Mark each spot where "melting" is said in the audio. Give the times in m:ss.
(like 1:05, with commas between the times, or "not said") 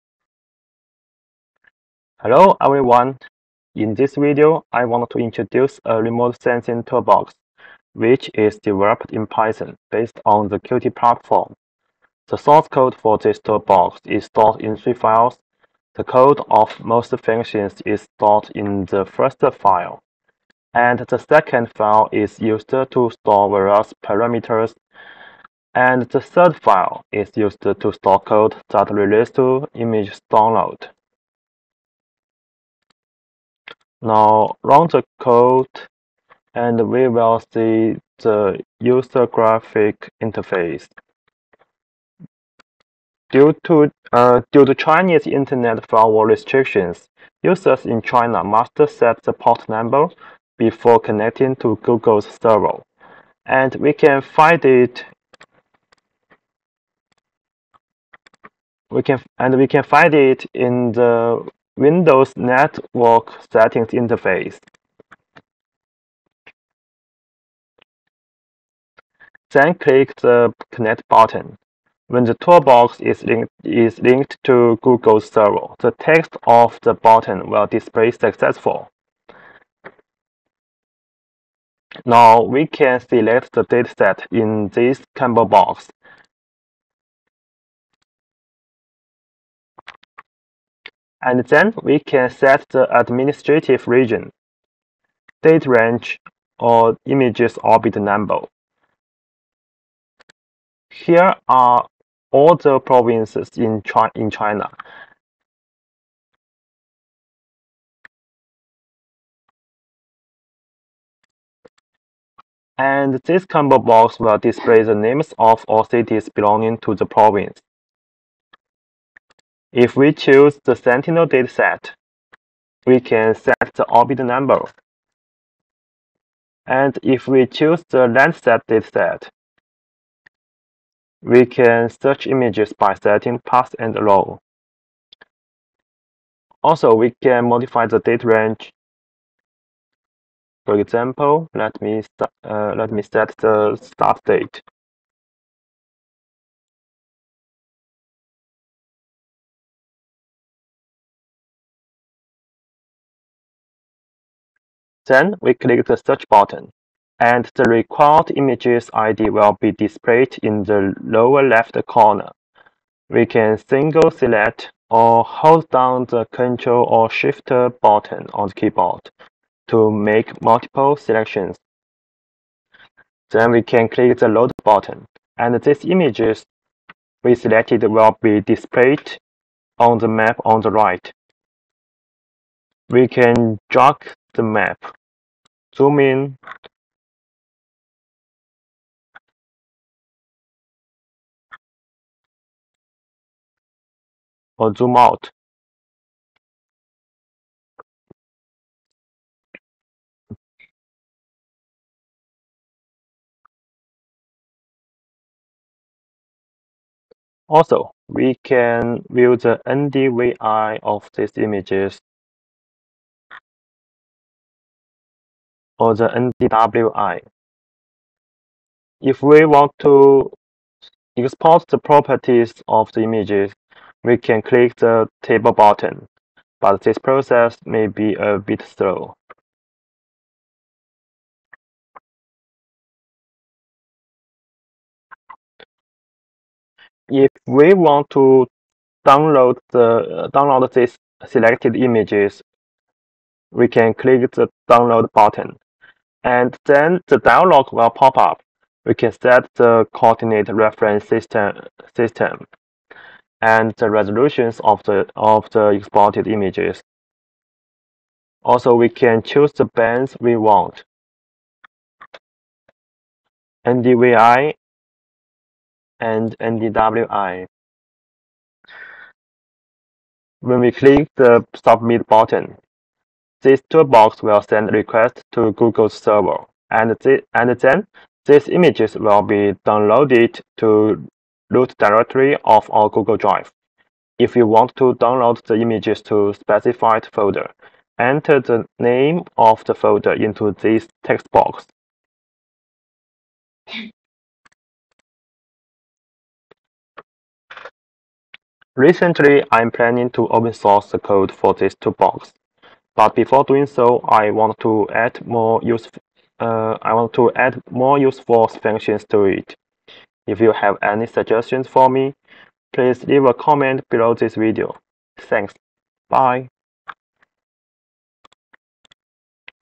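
not said.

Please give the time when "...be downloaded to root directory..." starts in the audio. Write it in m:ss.
4:39.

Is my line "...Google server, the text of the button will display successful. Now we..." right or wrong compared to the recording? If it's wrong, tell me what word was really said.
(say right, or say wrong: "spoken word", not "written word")
right.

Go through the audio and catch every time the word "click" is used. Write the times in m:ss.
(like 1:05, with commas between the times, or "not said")
1:09, 2:35, 2:53, 3:44, 4:03, 4:30.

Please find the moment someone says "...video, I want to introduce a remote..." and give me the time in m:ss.
0:04.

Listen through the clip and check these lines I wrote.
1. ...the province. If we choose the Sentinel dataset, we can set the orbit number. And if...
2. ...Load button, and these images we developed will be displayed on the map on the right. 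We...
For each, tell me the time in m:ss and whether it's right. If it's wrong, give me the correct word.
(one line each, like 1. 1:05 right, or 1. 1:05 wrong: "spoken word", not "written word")
1. 1:56 right
2. 2:54 wrong: "selected", not "developed".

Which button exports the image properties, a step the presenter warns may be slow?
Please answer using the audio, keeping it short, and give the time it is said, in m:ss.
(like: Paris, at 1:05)
table, at 3:45.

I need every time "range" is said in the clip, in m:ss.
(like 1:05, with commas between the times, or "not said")
1:35, 2:18.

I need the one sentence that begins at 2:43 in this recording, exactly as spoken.
We can single select or hold down the Ctrl or Shift button on the keyboard to make multiple selections.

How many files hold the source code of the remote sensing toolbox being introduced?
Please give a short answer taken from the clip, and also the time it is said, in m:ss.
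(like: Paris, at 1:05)
3, at 0:14.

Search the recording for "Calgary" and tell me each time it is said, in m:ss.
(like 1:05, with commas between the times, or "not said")
not said.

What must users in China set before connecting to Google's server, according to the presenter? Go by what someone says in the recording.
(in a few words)
port number.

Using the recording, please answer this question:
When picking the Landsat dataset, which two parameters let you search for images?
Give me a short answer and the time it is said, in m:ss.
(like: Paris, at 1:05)
path and row, at 2:13.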